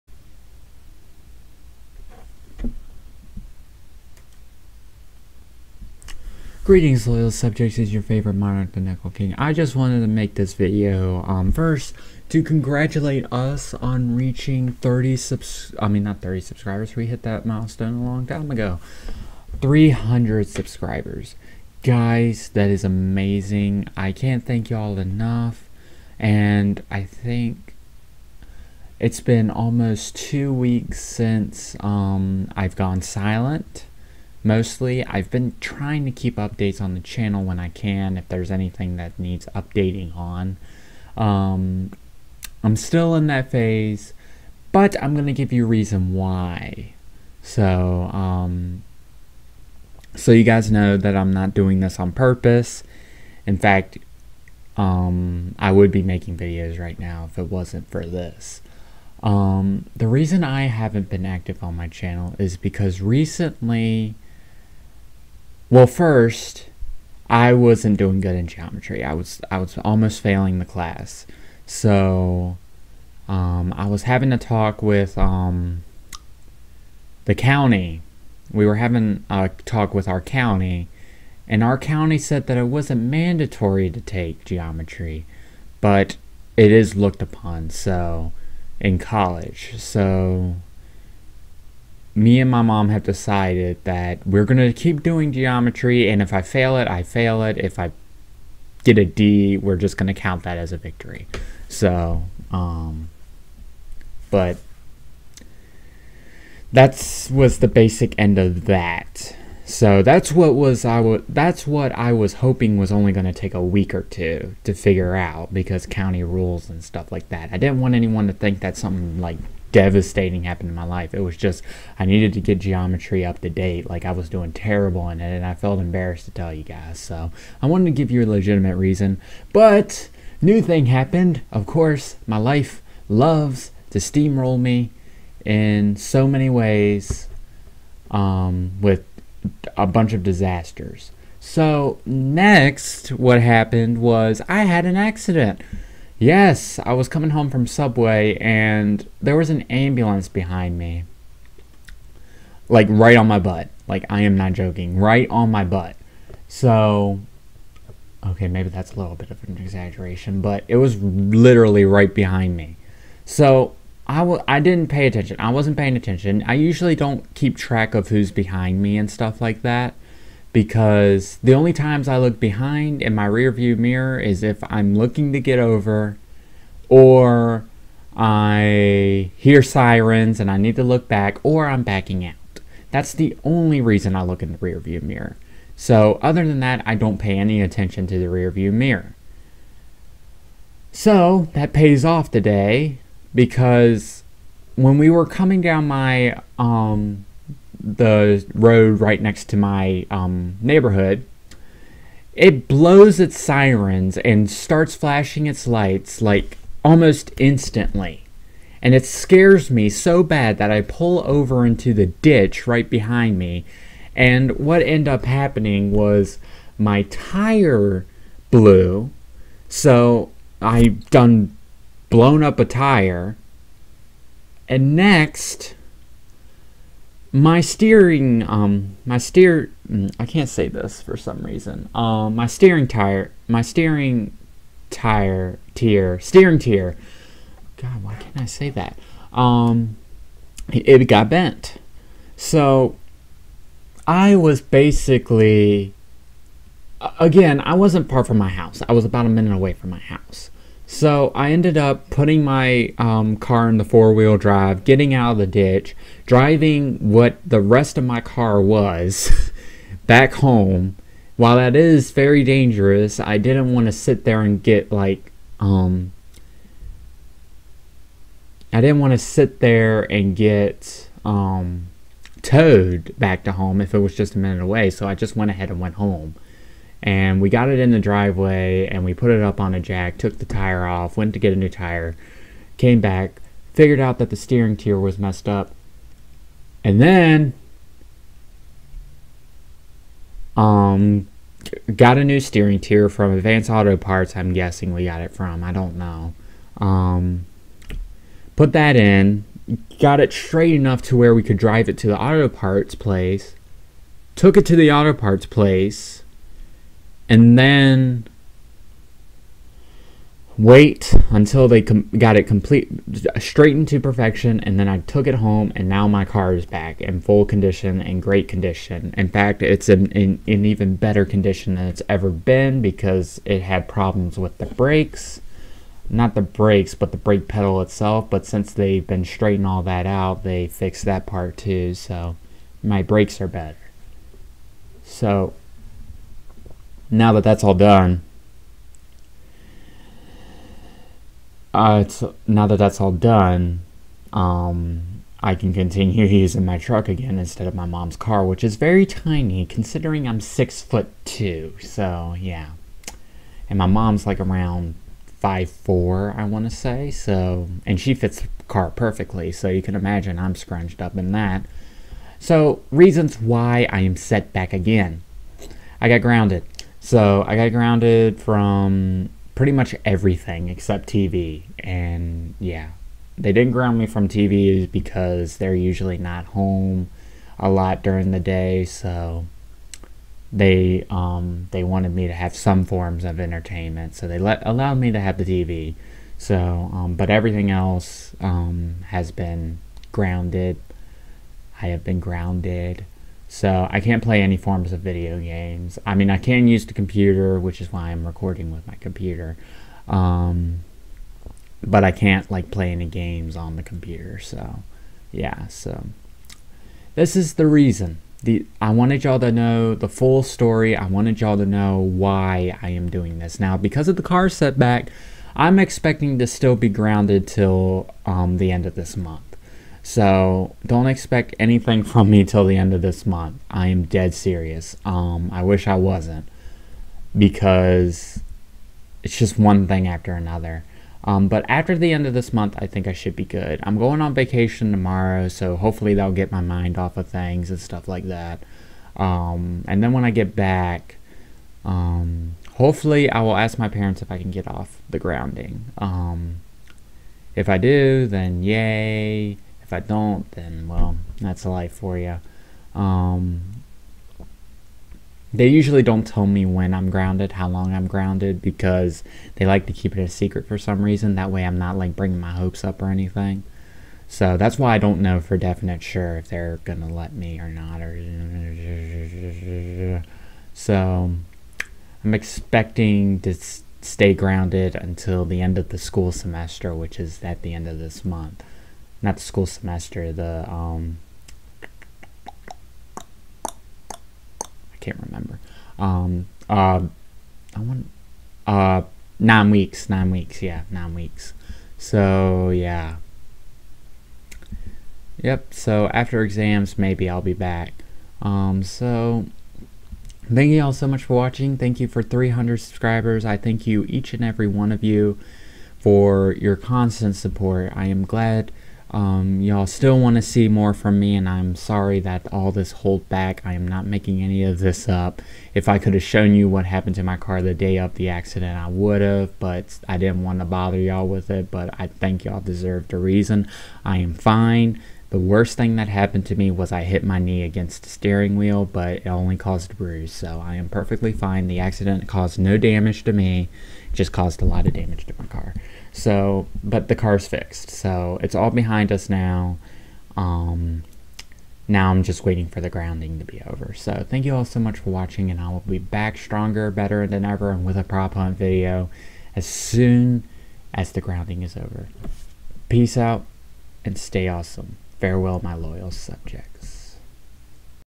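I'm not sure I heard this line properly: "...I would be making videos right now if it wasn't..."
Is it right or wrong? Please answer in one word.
right.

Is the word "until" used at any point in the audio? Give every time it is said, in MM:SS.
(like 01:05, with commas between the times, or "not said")
05:11, 07:54.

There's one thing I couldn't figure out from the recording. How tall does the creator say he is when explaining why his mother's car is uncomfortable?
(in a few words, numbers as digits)
6 foot 2.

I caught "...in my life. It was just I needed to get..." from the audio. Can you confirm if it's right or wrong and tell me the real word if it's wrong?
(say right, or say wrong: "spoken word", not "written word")
right.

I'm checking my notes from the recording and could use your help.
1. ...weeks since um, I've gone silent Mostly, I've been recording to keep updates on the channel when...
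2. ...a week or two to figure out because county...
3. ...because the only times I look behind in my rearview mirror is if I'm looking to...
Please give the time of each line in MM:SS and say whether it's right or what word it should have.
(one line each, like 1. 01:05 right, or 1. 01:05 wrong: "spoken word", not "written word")
1. 00:30 wrong: "trying", not "recording"
2. 01:53 right
3. 02:50 right.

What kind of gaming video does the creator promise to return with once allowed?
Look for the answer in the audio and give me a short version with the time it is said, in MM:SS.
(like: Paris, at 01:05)
prop hunt, at 09:08.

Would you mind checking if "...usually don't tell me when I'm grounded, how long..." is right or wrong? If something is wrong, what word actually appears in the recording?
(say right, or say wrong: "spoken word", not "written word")
right.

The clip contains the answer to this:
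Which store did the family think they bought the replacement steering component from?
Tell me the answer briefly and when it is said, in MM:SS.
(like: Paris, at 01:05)
Advance Auto Parts, at 04:53.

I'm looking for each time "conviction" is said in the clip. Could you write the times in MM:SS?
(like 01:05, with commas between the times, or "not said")
not said.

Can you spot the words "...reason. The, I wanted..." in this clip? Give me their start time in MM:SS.
06:47.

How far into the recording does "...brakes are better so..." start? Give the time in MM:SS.
05:33.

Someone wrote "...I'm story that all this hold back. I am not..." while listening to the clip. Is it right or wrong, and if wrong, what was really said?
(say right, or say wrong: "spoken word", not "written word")
wrong: "sorry", not "story".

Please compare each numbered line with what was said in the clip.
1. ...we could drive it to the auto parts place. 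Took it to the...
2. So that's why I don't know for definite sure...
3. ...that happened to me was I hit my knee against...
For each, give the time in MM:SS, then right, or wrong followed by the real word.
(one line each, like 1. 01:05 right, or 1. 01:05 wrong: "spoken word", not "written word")
1. 05:01 right
2. 07:44 right
3. 08:45 right.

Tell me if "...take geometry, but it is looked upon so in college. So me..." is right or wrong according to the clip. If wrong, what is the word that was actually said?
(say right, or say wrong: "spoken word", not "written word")
right.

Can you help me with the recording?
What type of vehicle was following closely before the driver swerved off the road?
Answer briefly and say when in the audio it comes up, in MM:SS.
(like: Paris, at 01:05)
ambulance, at 02:29.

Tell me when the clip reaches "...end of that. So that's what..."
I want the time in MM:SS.
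01:48.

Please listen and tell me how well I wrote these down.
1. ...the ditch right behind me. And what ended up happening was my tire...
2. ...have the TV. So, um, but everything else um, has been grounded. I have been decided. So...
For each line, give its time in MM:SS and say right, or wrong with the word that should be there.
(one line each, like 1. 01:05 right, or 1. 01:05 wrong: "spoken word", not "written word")
1. 03:31 right
2. 06:25 wrong: "grounded", not "decided".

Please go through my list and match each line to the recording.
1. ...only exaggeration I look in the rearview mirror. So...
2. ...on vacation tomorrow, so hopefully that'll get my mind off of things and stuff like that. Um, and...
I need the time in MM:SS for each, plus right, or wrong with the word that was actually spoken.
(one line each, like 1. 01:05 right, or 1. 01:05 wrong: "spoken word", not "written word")
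1. 03:03 wrong: "reason", not "exaggeration"
2. 07:14 right.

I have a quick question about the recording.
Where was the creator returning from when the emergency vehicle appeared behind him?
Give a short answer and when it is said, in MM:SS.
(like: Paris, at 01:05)
Subway, at 02:27.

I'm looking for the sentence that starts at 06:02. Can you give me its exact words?
So reasons why I am set back again.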